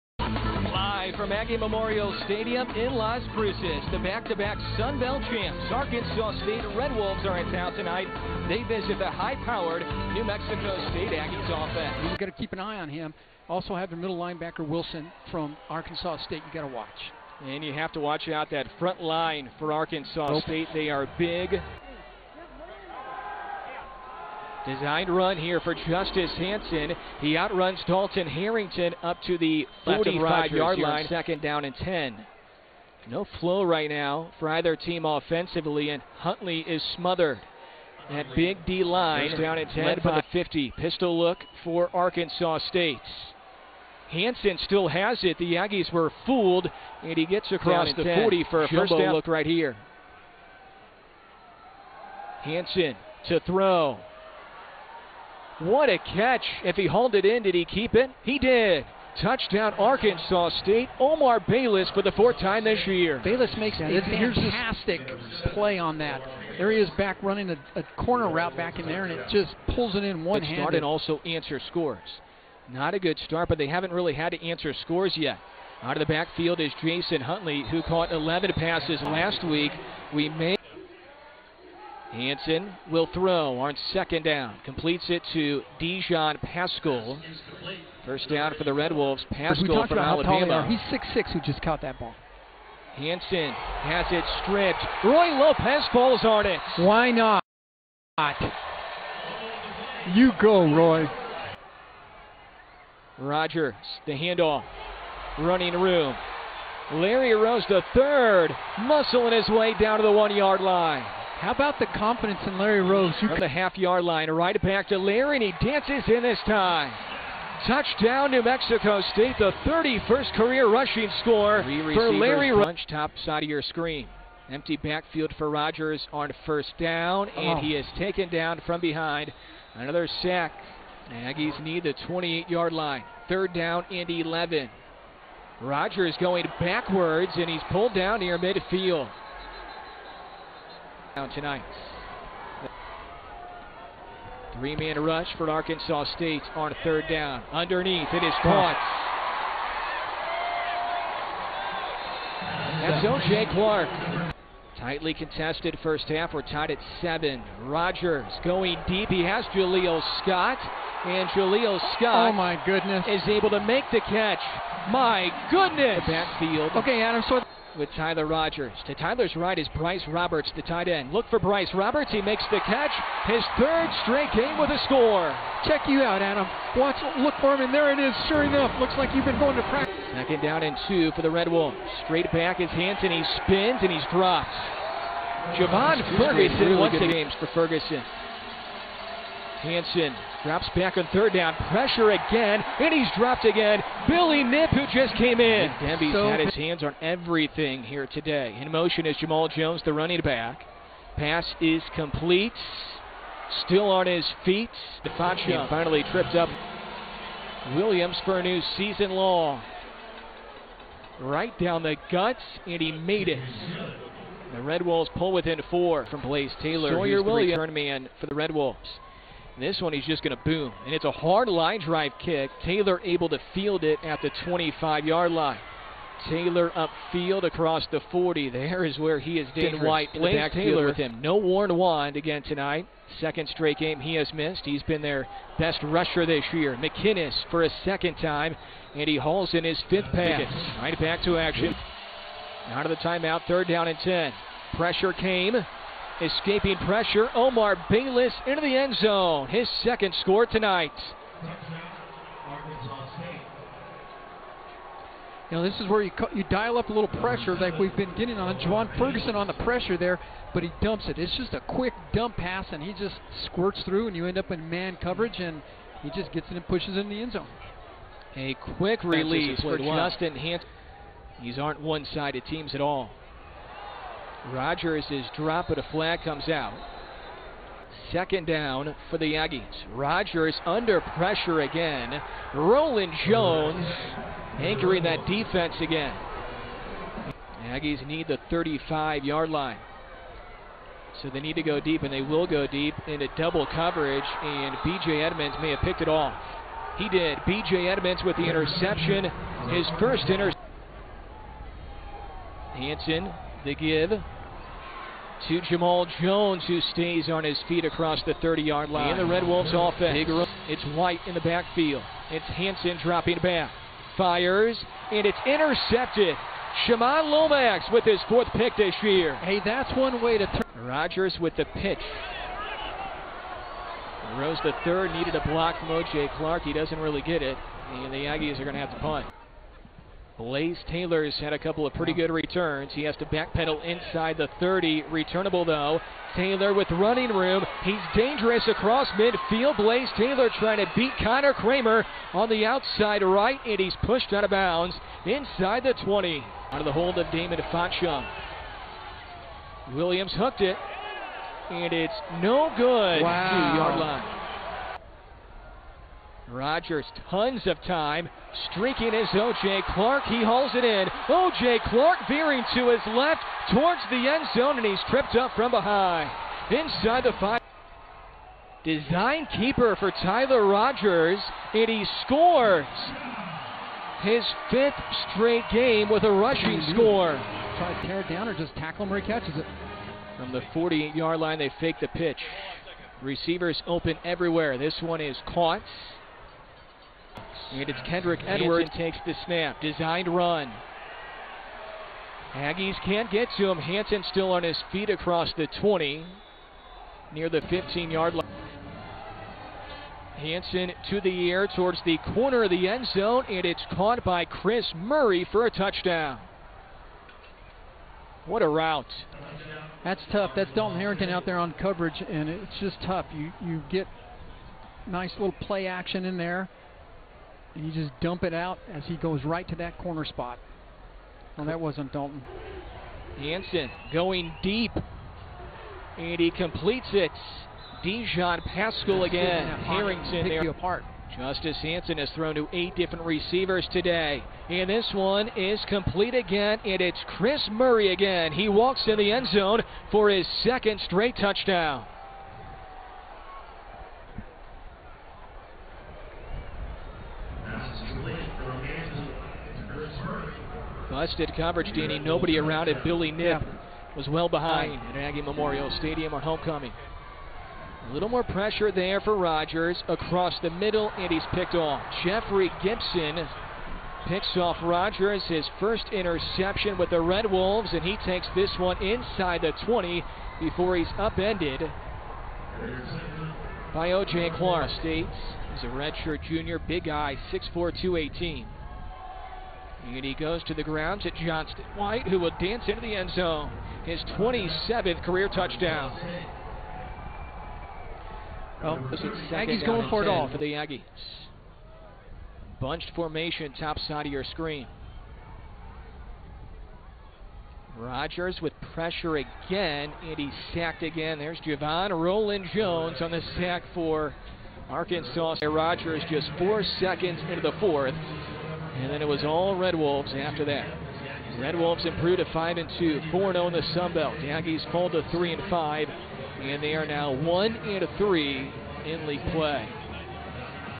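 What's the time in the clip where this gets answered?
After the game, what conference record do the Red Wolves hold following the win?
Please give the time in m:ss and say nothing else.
8:33.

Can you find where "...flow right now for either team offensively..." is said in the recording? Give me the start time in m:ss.
0:33.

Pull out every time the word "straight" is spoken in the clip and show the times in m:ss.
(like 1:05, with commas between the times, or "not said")
2:54, 3:02, 3:53, 6:15, 7:21.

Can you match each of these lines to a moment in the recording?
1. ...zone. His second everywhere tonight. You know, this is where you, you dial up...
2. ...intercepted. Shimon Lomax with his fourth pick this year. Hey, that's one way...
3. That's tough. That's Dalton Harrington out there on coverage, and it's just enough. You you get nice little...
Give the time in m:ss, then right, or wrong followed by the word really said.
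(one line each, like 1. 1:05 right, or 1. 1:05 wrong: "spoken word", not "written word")
1. 4:08 wrong: "score", not "everywhere"
2. 5:15 right
3. 6:50 wrong: "tough", not "enough".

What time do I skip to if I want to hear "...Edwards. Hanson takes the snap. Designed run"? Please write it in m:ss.
6:28.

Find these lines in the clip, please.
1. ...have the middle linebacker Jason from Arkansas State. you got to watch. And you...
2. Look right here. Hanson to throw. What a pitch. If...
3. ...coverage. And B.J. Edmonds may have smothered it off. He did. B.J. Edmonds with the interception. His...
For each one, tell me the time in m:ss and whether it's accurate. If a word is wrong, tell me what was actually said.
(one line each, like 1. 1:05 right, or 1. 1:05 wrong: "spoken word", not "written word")
1. 0:13 wrong: "Wilson", not "Jason"
2. 0:49 wrong: "catch", not "pitch"
3. 4:53 wrong: "picked", not "smothered".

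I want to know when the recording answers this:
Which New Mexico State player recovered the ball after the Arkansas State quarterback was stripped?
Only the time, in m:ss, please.
1:35.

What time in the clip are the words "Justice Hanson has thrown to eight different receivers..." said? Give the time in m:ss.
7:11.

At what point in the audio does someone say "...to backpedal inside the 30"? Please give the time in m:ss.
5:33.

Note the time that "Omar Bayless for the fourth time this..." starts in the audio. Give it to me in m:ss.
1:00.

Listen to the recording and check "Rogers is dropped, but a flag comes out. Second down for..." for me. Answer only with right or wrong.
right.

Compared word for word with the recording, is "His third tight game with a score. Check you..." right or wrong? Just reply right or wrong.
wrong.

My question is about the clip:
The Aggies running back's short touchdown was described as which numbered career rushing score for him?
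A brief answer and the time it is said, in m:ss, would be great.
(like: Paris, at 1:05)
31st, at 1:59.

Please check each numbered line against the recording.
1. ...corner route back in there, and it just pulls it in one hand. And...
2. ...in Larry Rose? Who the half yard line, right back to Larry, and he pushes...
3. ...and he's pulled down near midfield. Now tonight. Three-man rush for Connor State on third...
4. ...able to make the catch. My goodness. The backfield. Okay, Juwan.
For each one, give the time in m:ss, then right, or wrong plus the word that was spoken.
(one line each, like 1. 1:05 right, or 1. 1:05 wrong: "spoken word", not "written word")
1. 1:08 right
2. 1:52 wrong: "dances", not "pushes"
3. 2:17 wrong: "Arkansas", not "Connor"
4. 2:43 wrong: "Adam", not "Juwan".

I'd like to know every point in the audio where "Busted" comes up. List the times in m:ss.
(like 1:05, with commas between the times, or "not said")
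7:31.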